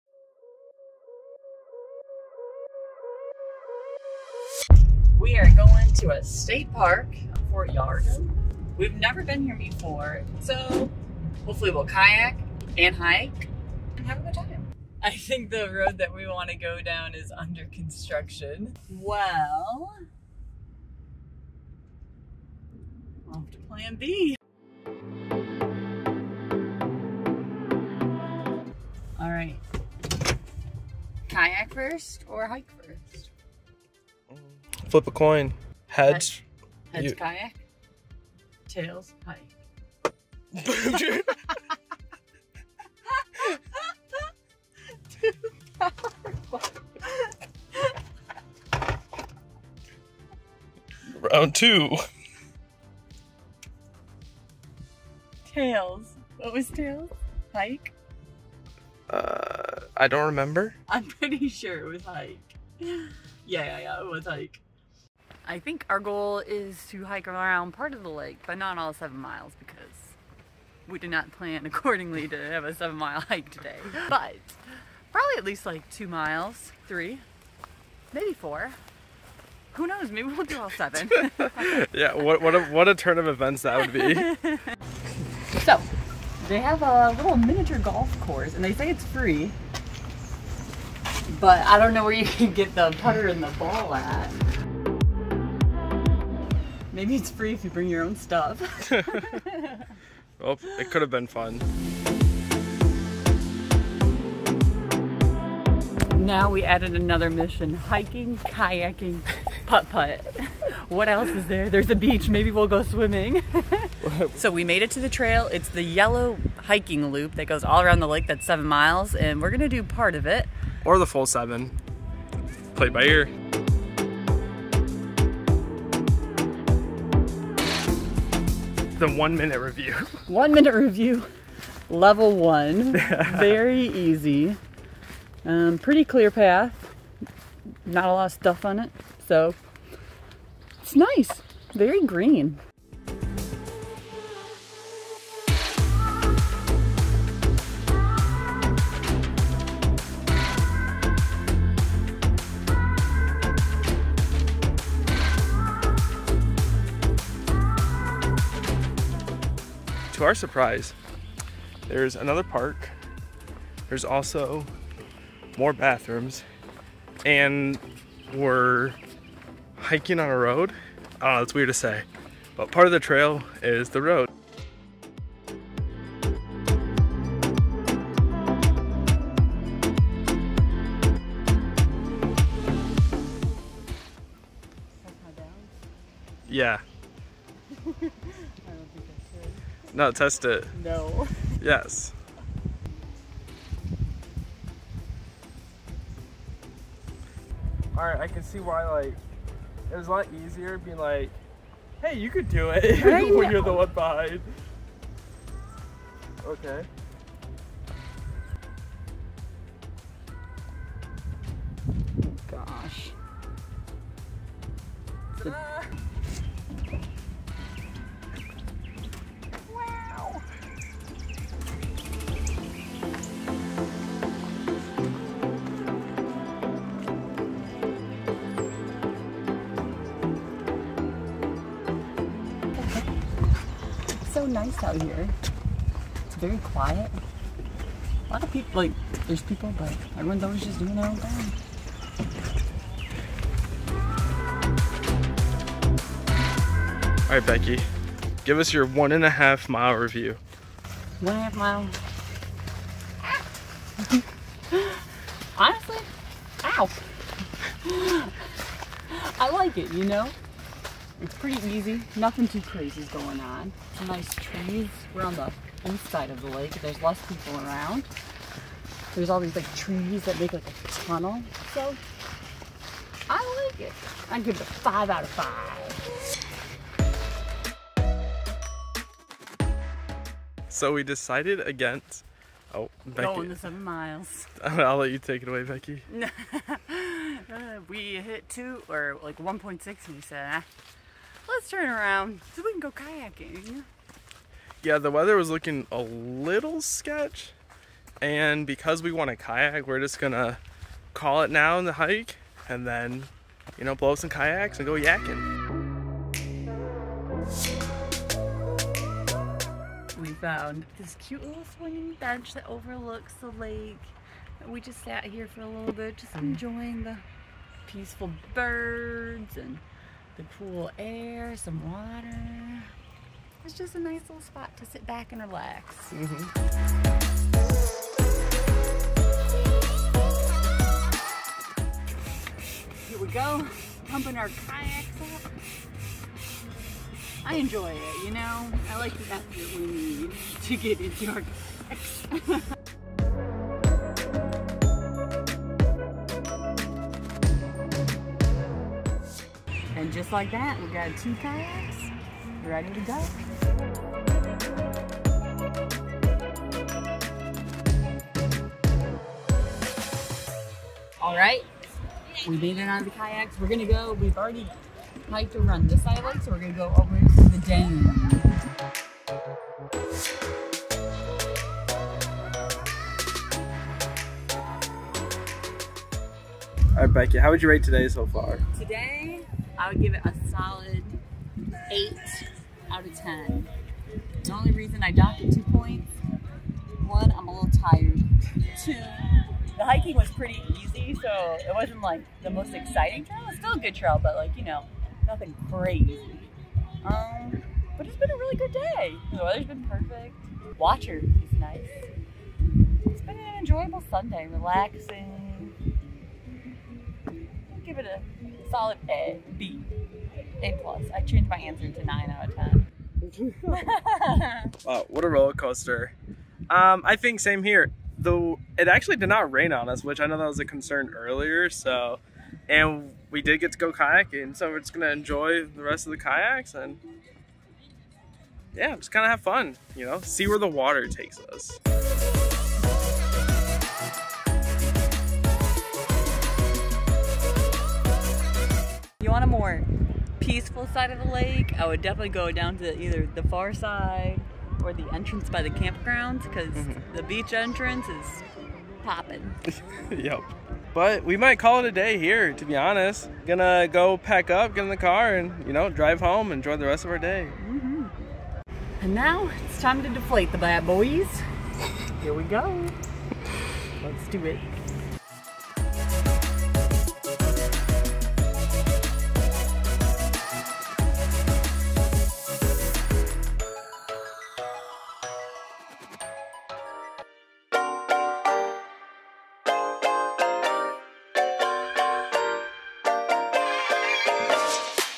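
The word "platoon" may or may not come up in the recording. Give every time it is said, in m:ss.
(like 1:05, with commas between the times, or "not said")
not said.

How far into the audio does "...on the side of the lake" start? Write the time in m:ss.
4:25.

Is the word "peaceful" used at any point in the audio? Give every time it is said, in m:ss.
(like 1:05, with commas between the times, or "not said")
5:17, 7:20.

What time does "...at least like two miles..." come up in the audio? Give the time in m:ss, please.
1:15.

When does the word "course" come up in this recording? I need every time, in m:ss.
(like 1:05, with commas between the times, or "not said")
1:28.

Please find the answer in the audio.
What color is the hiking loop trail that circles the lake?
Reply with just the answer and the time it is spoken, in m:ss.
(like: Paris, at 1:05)
Yellow, at 1:55.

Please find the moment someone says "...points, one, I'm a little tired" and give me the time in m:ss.
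6:25.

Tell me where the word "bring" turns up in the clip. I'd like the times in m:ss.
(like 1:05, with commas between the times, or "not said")
1:37.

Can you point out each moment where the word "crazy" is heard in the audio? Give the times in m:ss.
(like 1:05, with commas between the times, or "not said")
4:22, 6:35.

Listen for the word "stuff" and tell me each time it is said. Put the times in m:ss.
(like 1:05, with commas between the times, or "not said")
1:38, 2:18.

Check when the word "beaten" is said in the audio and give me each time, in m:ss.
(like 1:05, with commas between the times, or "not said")
not said.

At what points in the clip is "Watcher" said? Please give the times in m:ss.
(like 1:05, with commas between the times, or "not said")
6:40.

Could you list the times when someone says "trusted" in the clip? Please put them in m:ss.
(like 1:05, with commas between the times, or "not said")
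not said.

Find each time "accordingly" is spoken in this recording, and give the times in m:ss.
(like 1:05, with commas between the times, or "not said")
1:11.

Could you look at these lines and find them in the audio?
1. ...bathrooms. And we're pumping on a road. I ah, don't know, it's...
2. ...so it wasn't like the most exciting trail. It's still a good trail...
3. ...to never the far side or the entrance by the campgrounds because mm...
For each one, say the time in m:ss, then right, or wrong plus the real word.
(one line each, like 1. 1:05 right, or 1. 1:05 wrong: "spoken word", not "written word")
1. 2:45 wrong: "hiking", not "pumping"
2. 6:31 right
3. 7:22 wrong: "either", not "never".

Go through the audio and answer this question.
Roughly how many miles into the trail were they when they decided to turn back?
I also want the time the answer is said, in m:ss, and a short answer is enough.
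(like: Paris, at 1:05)
1.6, at 4:49.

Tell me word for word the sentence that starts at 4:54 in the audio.
Yeah, the weather was looking a little sketch.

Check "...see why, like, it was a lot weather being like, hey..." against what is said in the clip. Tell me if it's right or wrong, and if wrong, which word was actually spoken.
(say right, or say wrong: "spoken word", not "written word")
wrong: "easier", not "weather".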